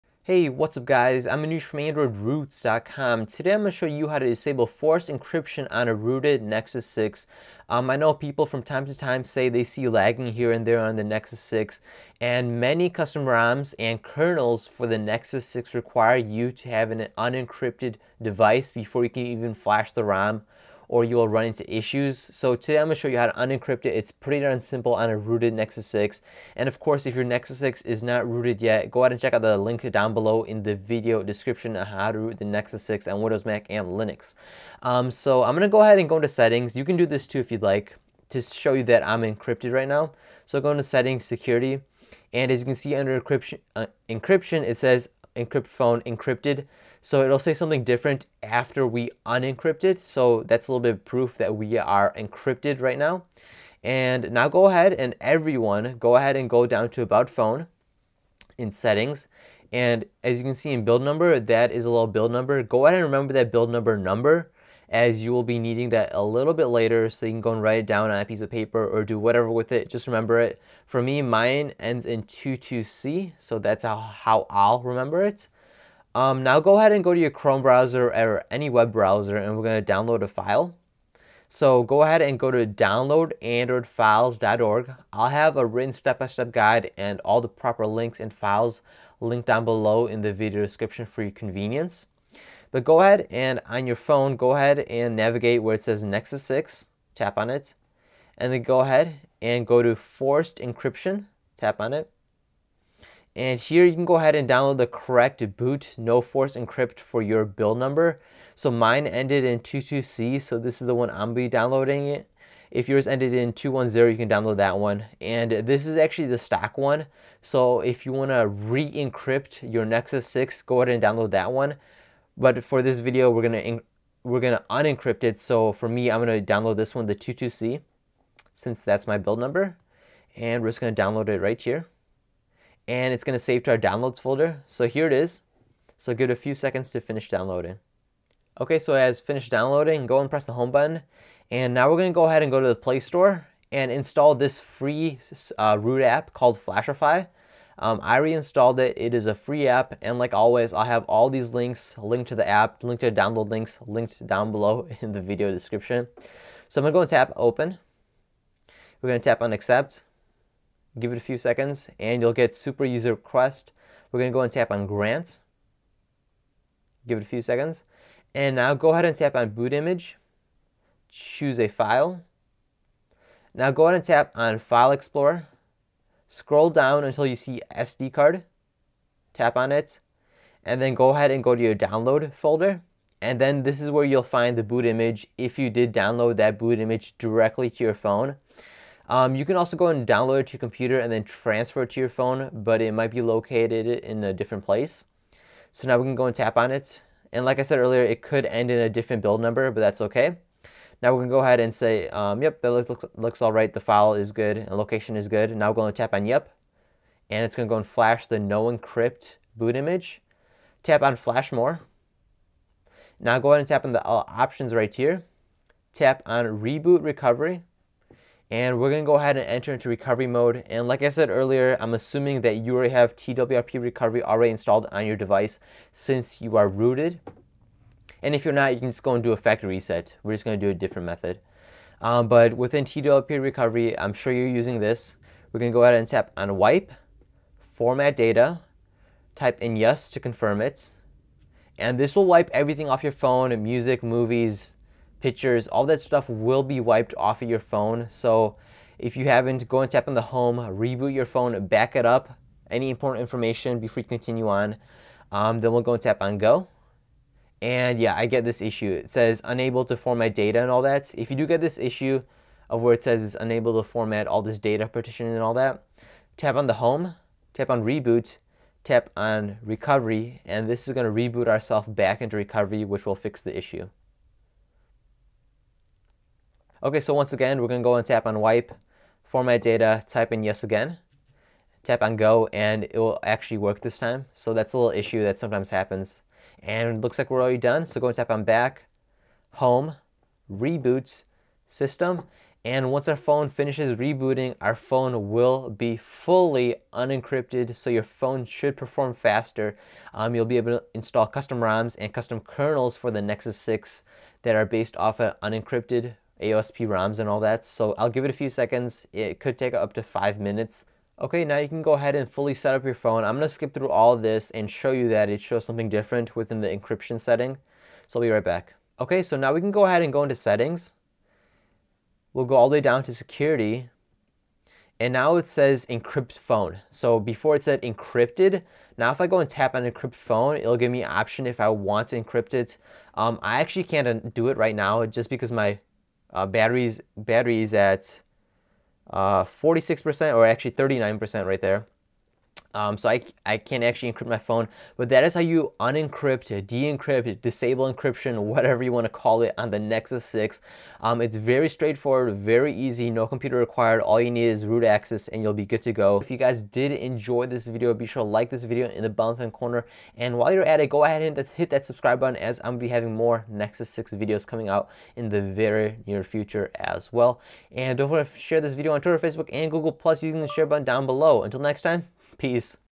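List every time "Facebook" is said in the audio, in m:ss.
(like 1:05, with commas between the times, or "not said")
6:09.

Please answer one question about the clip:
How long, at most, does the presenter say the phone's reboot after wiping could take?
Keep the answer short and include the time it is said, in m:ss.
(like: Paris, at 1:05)
5 minutes, at 5:10.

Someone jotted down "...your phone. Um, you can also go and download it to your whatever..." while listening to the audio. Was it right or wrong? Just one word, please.
wrong.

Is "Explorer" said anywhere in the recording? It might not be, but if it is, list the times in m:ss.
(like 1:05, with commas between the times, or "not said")
2:54.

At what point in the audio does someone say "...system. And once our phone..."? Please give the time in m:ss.
4:51.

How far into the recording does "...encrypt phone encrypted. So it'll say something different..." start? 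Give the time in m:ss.
0:45.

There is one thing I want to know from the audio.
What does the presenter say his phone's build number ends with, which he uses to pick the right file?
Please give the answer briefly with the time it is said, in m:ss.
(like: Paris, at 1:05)
22C, at 1:11.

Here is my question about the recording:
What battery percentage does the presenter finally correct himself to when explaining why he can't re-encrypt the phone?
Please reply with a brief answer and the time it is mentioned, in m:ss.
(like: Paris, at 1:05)
39%, at 5:40.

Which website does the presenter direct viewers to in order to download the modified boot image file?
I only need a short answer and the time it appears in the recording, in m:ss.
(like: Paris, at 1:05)
downloadandroidfiles.org, at 1:22.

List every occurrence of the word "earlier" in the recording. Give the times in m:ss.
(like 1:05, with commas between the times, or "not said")
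3:17, 3:41.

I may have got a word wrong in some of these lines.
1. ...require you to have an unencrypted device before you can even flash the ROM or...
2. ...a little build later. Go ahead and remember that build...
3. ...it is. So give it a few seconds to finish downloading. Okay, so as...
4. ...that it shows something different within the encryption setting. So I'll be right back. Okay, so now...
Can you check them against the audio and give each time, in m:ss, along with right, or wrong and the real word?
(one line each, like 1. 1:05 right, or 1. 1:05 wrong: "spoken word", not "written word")
1. 0:15 right
2. 1:01 wrong: "number", not "later"
3. 2:15 right
4. 5:15 right.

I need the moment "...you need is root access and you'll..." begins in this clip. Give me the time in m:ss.
5:54.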